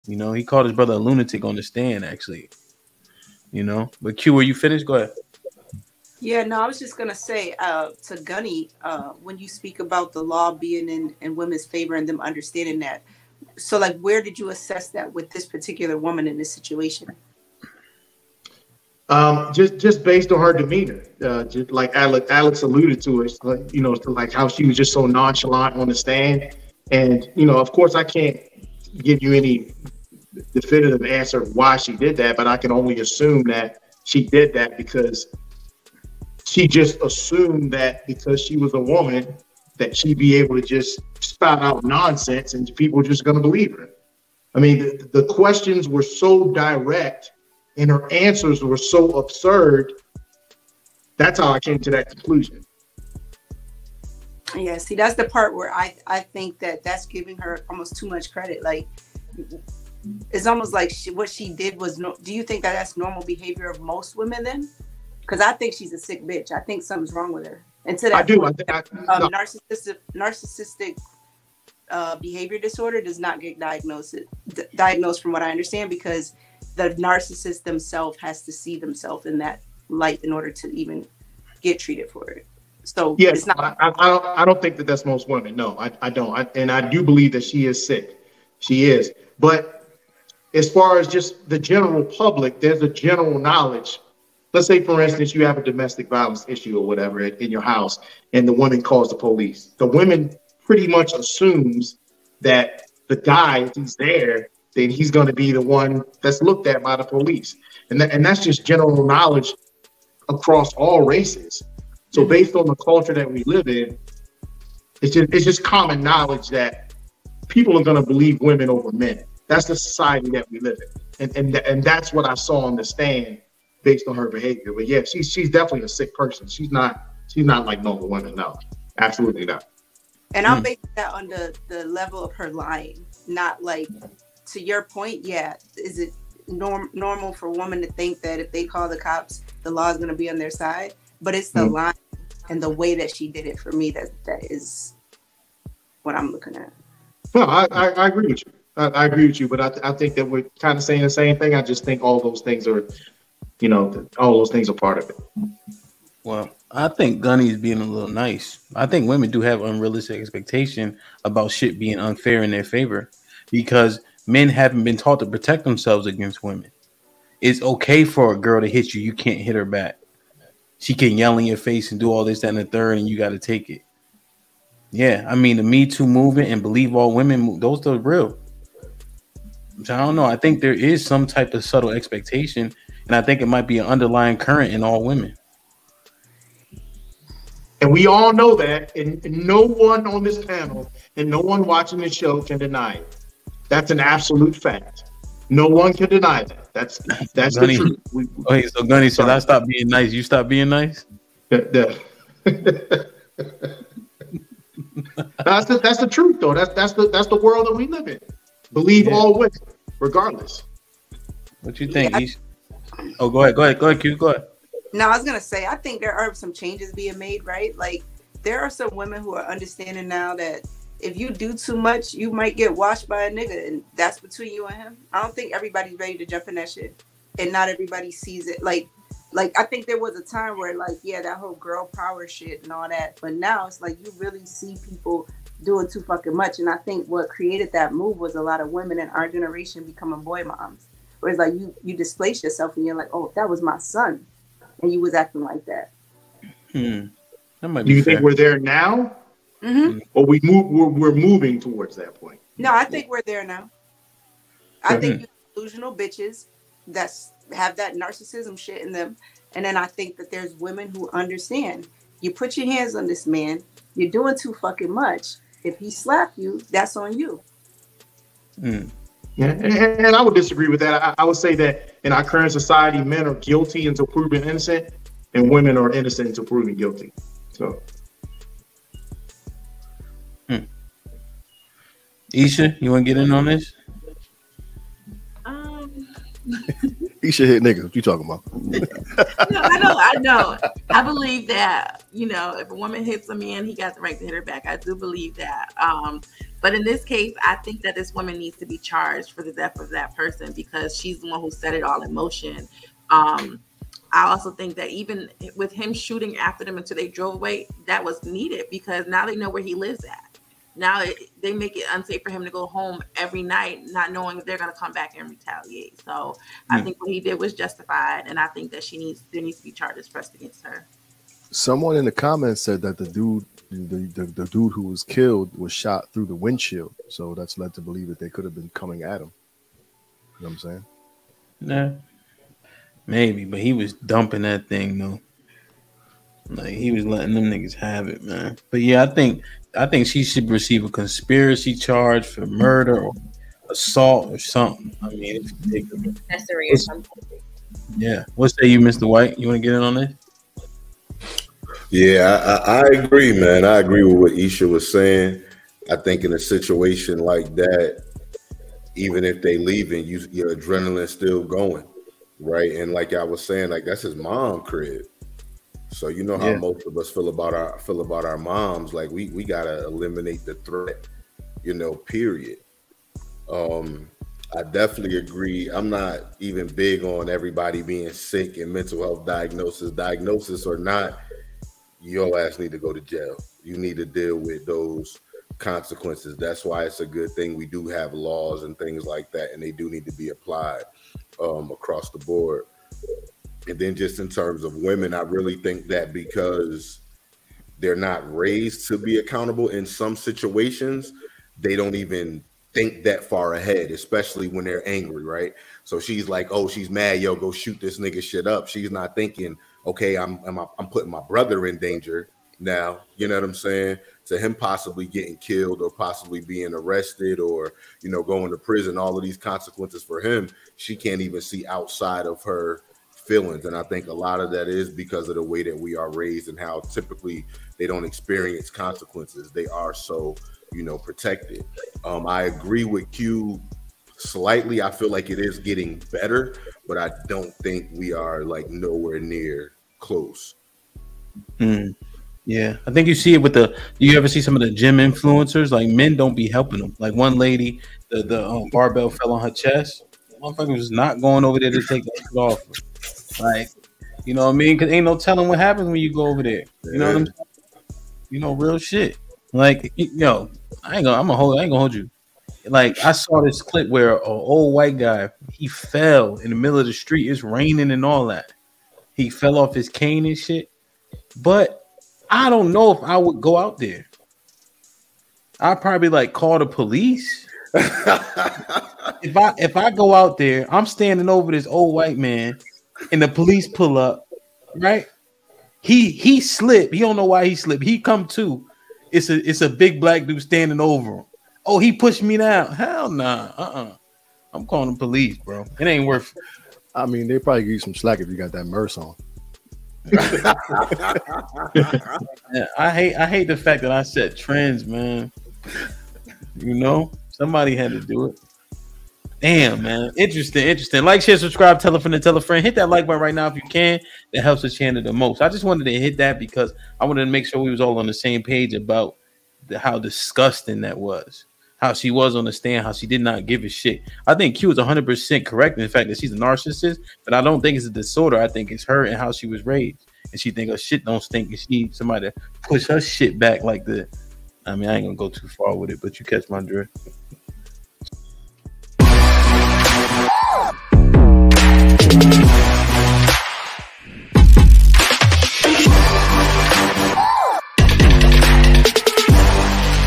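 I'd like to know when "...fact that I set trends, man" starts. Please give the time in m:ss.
8:23.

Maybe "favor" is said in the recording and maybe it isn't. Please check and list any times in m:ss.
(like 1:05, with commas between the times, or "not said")
0:11, 2:42.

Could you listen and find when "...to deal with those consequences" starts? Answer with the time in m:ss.
6:23.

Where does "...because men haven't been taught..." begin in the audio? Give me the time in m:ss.
2:43.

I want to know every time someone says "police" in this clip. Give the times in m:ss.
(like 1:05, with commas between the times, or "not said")
1:39, 1:47, 7:56, 8:03, 8:14.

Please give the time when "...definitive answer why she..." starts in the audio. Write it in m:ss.
0:30.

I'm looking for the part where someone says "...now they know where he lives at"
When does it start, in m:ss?
5:09.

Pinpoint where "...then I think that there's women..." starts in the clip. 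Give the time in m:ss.
4:19.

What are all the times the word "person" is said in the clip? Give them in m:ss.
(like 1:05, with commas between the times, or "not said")
2:06, 5:00.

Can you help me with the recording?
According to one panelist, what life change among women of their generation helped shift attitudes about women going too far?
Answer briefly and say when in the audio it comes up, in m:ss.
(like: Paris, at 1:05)
Becoming boy moms, at 3:59.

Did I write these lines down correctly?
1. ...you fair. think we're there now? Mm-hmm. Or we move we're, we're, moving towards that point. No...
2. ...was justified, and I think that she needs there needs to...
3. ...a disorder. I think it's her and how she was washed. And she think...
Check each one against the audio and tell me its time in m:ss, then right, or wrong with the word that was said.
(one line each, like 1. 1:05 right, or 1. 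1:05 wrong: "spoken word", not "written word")
1. 4:07 right
2. 5:17 right
3. 8:47 wrong: "raised", not "washed".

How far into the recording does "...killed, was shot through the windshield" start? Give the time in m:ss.
5:25.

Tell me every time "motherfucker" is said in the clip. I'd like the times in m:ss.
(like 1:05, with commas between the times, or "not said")
7:30.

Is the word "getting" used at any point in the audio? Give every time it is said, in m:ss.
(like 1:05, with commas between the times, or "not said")
6:55, 7:15.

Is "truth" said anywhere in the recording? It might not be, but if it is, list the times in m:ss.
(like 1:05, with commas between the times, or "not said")
3:18, 3:26.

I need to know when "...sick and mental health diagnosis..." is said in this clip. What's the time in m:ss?
6:18.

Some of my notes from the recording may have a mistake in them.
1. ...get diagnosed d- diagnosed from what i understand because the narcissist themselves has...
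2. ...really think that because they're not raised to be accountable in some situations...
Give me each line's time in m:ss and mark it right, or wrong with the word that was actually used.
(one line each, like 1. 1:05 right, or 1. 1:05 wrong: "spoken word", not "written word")
1. 1:13 right
2. 6:35 right.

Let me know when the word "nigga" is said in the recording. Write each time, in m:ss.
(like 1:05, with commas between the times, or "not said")
3:43, 4:47, 5:37, 6:47.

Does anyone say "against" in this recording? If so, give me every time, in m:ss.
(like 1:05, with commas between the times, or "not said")
2:46, 5:20.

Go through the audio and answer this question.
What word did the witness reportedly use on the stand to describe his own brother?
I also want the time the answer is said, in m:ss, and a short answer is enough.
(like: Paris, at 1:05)
Lunatic, at 0:00.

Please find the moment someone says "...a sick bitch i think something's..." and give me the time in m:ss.
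1:05.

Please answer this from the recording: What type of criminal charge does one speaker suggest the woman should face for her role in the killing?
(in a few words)
Conspiracy.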